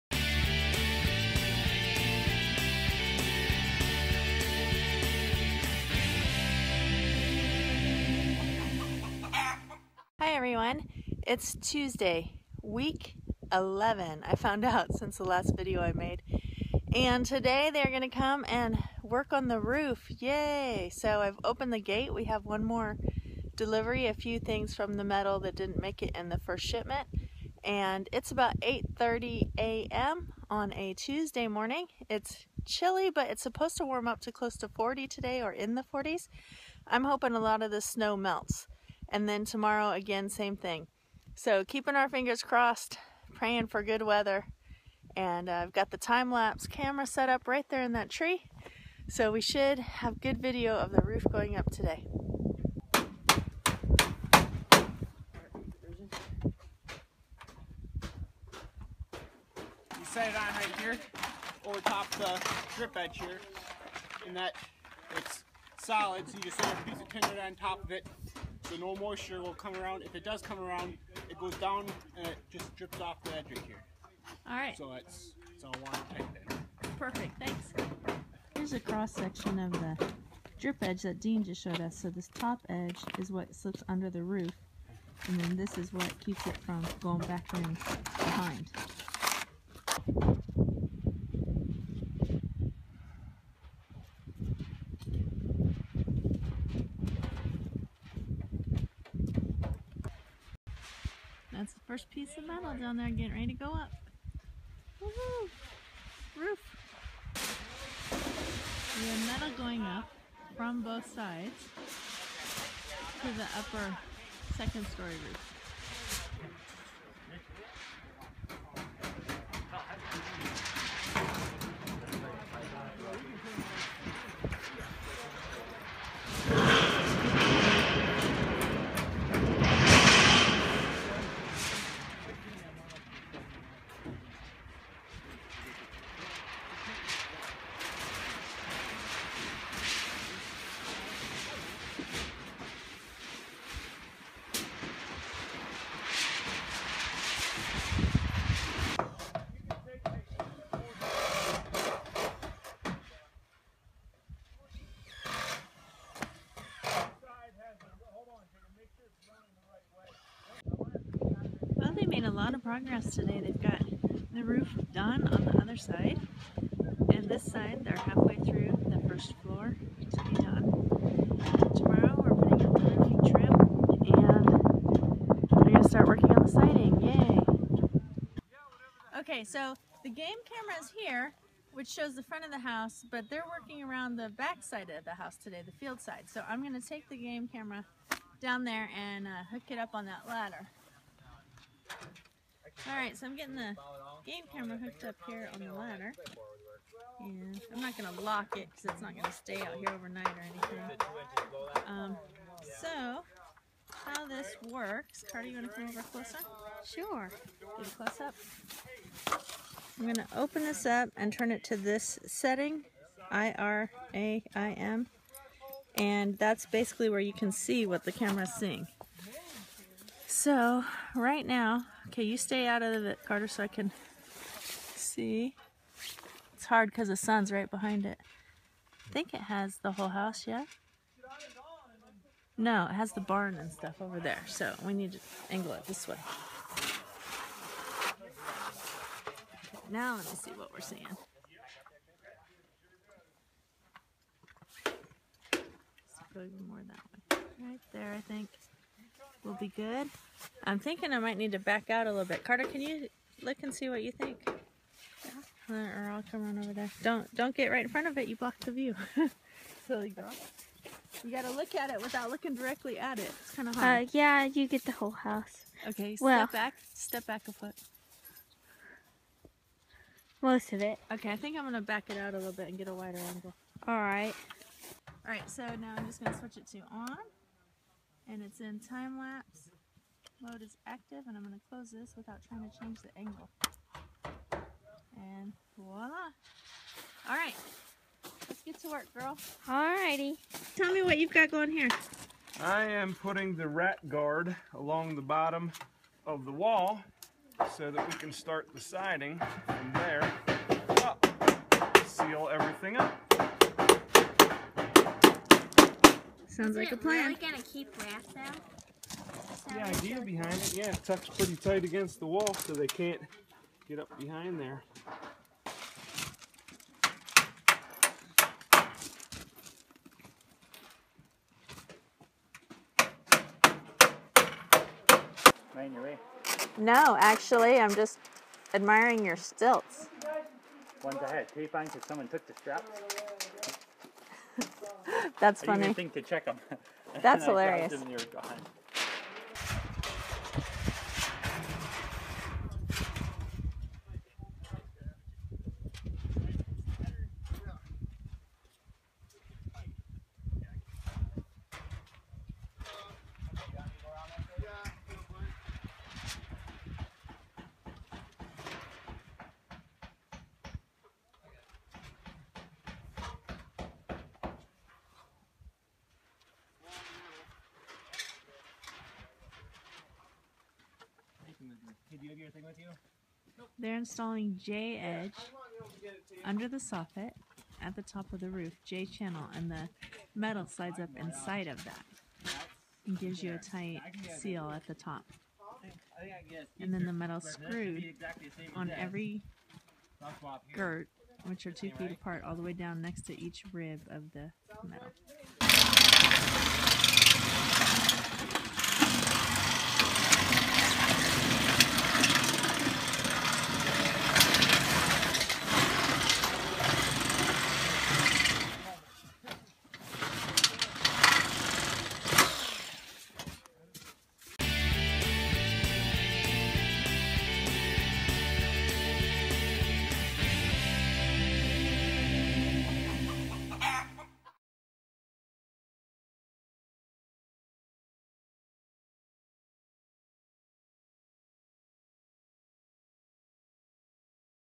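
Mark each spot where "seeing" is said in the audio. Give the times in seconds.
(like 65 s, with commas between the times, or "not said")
218 s, 240 s.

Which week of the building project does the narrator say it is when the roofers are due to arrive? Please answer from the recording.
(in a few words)
Week 11.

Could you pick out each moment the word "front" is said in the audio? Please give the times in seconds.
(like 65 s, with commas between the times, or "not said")
182 s, 257 s.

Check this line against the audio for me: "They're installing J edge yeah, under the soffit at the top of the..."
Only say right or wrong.
right.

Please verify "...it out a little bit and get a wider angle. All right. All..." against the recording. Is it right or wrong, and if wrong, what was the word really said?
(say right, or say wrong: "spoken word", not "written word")
right.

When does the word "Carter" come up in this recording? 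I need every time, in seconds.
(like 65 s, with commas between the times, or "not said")
205 s, 223 s, 252 s.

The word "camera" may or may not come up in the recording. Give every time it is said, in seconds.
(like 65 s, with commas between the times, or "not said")
46 s, 180 s, 187 s, 194 s, 218 s.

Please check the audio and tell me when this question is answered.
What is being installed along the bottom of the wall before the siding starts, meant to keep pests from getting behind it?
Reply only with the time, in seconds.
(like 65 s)
293 s.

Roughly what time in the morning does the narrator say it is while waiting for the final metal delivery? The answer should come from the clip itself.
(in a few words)
8:30 a.m.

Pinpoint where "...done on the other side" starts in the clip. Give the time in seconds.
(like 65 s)
164 s.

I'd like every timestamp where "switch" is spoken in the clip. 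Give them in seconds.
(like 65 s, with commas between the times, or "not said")
276 s.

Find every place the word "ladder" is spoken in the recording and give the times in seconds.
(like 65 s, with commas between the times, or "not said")
190 s, 195 s.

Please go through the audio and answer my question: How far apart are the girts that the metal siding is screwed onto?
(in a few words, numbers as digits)
2 feet.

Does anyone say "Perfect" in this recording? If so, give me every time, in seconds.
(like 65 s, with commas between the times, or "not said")
76 s.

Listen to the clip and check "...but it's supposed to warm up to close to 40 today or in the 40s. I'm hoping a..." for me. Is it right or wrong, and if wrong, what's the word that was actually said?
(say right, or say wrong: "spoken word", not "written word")
right.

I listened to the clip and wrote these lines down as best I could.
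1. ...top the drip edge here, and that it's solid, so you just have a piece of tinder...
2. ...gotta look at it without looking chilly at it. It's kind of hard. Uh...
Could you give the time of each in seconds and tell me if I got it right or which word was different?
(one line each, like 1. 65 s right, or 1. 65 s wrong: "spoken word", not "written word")
1. 61 s right
2. 261 s wrong: "directly", not "chilly".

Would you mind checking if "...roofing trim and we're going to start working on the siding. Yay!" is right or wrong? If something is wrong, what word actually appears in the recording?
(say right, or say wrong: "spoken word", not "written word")
right.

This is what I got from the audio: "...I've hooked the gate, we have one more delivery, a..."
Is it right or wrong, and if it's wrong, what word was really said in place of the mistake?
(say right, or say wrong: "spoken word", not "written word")
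wrong: "opened", not "hooked".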